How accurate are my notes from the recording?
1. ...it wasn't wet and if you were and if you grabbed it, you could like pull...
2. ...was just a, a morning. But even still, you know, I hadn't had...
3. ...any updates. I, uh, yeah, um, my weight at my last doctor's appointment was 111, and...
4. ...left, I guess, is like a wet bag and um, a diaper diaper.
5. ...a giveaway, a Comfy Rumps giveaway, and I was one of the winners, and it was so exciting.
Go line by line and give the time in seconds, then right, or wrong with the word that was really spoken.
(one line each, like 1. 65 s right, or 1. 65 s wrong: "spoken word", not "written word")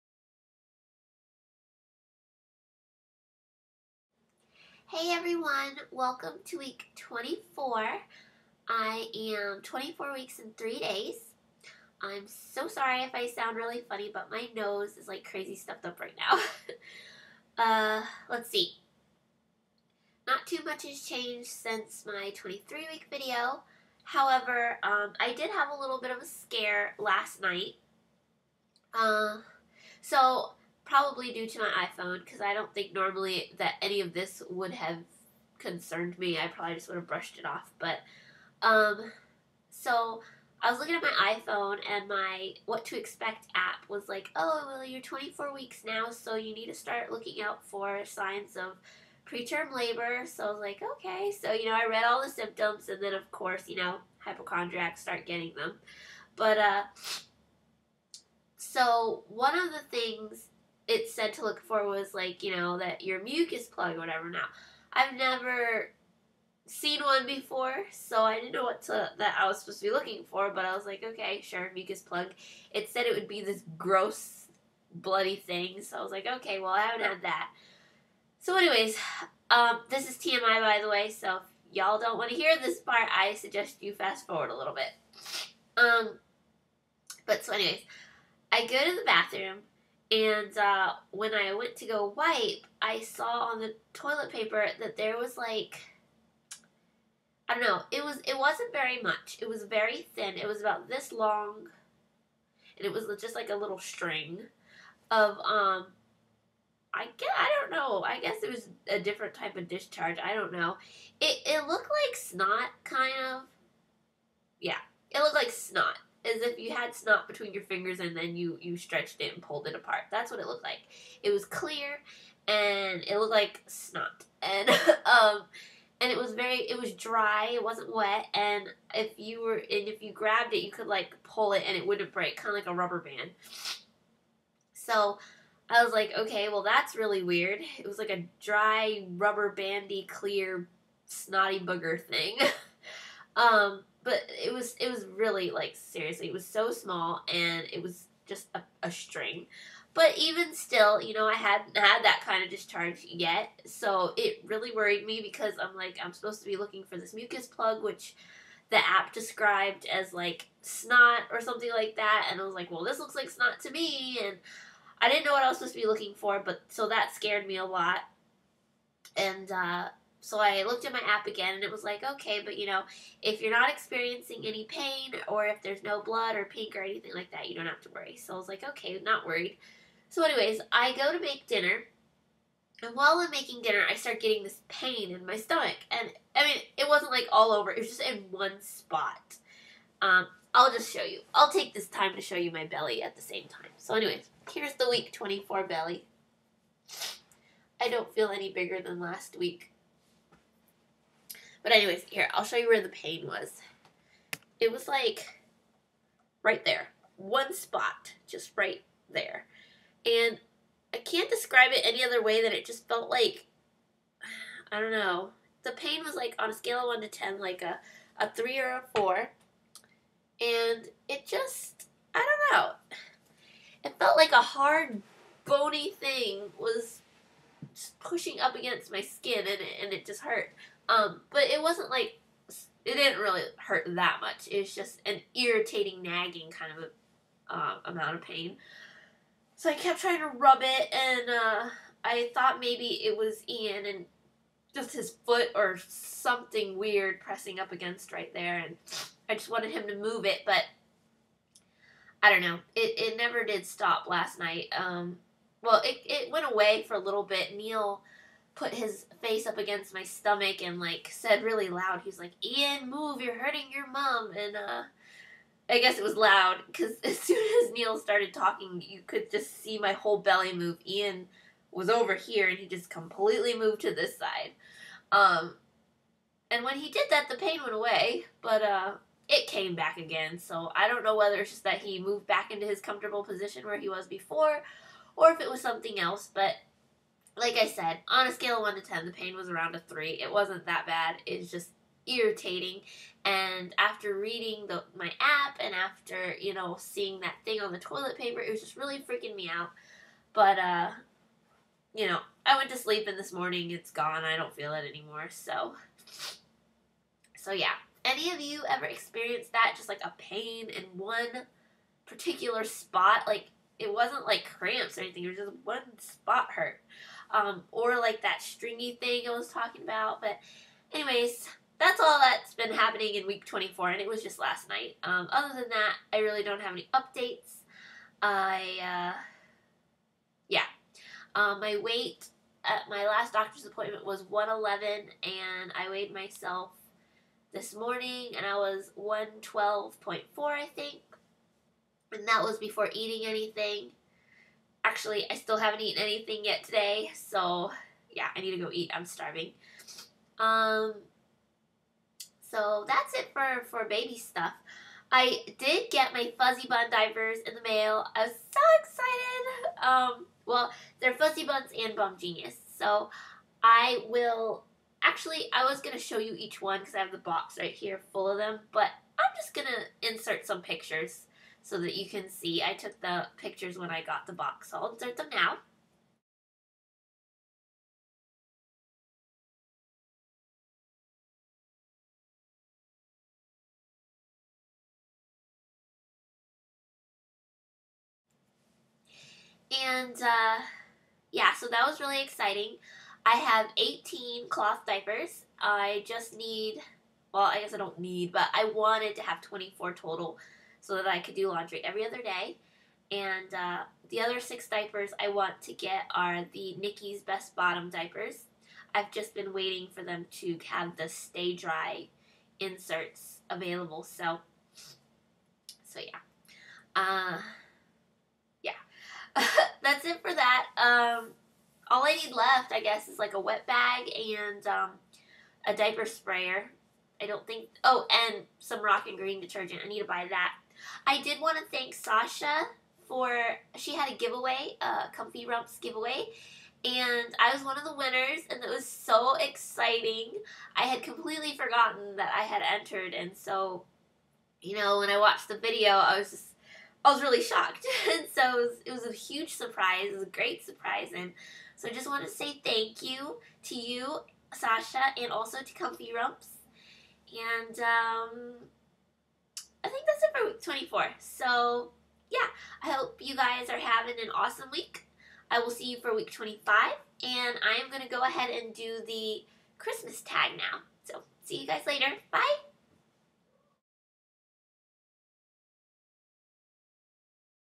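1. 127 s right
2. 147 s wrong: "string", not "morning"
3. 326 s right
4. 422 s wrong: "sprayer", not "diaper"
5. 434 s right.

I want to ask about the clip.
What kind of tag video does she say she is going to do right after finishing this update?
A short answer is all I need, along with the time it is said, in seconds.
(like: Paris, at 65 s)
Christmas tag, at 469 s.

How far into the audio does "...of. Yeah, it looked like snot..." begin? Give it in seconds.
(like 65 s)
113 s.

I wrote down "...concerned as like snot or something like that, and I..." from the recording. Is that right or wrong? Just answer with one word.
wrong.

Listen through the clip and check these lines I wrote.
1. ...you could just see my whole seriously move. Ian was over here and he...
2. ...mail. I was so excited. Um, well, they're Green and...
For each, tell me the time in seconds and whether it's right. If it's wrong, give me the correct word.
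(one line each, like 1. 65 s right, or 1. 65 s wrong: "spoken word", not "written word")
1. 268 s wrong: "belly", not "seriously"
2. 357 s wrong: "FuzziBunz", not "Green".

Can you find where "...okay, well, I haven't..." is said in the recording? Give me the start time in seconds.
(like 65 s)
76 s.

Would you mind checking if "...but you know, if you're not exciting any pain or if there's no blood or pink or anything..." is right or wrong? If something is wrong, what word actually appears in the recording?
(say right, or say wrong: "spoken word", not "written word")
wrong: "experiencing", not "exciting".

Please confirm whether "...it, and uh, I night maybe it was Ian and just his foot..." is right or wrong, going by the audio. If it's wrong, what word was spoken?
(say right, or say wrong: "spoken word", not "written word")
wrong: "thought", not "night".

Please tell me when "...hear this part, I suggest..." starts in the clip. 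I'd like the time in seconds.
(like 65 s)
82 s.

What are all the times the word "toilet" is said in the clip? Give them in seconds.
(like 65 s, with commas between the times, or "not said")
93 s, 297 s.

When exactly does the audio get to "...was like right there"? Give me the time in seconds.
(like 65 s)
204 s.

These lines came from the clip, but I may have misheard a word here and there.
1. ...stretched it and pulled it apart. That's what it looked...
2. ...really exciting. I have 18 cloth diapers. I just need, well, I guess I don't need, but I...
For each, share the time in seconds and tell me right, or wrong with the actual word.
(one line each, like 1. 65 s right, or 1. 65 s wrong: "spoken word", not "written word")
1. 118 s right
2. 392 s right.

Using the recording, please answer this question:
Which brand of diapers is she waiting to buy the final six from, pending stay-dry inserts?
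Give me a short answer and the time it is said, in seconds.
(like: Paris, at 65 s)
Nicki's Best Bottom, at 406 s.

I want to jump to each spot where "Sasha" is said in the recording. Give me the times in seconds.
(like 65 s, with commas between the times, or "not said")
431 s, 454 s.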